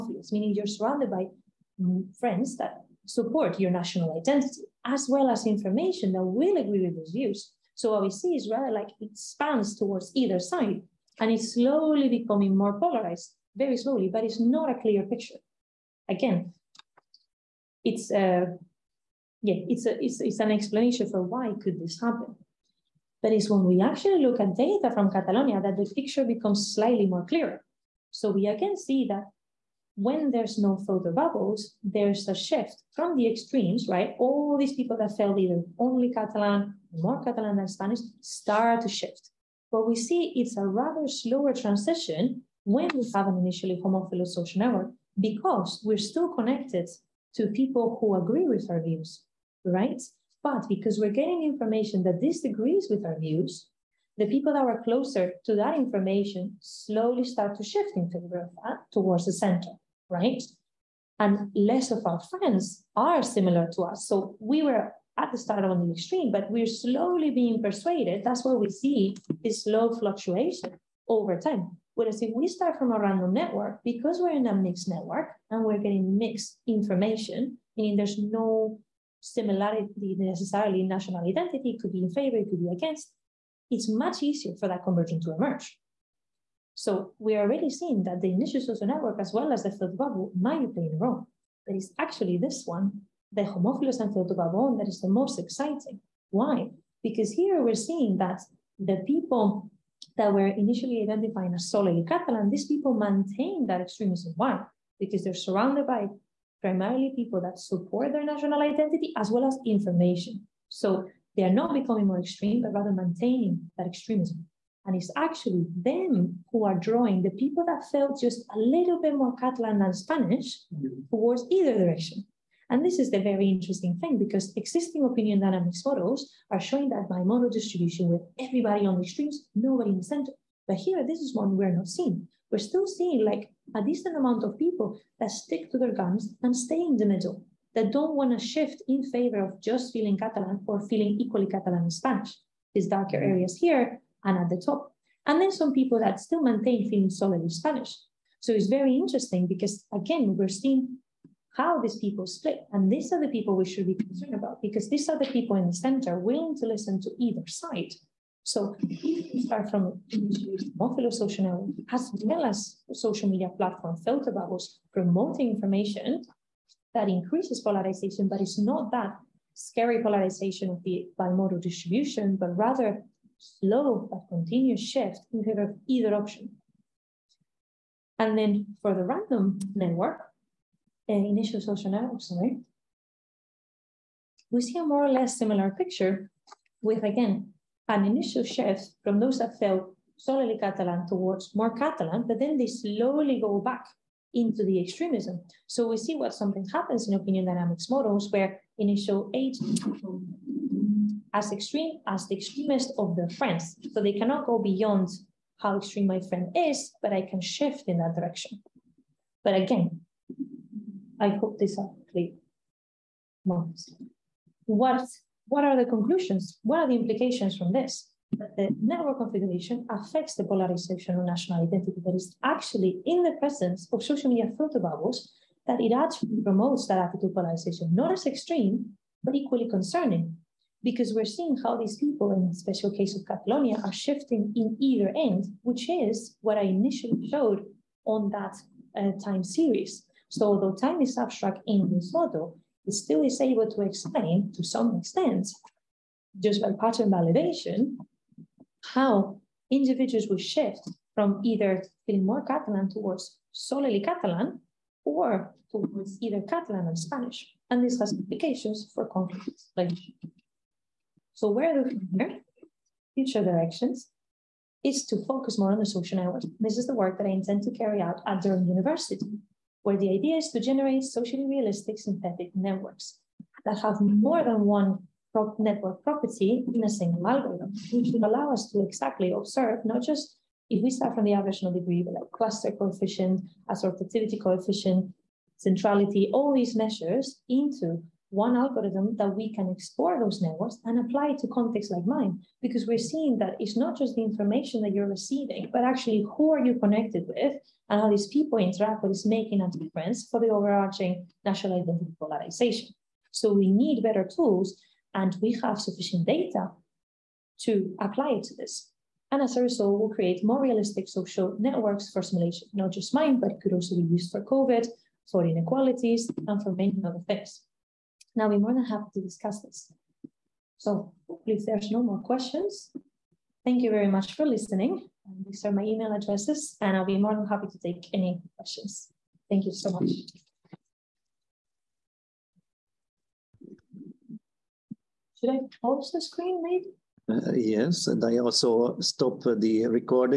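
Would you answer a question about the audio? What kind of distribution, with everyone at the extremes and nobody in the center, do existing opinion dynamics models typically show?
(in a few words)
Bimodal distribution.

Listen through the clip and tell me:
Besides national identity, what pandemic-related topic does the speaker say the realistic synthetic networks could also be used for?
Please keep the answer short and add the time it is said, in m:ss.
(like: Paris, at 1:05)
COVID, at 5:14.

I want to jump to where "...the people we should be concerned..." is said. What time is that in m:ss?
2:33.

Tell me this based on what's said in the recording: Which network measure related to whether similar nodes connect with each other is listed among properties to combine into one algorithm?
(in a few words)
Assortativity coefficient.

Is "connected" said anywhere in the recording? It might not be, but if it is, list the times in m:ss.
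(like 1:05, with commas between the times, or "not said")
0:46, 4:56.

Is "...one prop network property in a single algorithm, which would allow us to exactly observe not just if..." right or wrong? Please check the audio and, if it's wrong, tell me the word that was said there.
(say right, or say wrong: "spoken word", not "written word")
right.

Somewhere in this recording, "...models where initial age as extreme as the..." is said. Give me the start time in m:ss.
3:17.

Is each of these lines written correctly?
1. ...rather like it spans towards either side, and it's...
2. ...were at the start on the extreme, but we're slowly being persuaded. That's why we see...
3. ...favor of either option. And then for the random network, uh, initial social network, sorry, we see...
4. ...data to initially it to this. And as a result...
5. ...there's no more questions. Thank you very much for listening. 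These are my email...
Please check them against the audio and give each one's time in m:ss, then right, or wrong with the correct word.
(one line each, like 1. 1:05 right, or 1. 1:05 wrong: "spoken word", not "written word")
1. 0:08 right
2. 1:04 right
3. 2:55 right
4. 5:06 wrong: "apply", not "initially"
5. 5:21 right.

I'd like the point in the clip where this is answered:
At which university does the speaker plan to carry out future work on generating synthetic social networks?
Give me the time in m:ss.
4:28.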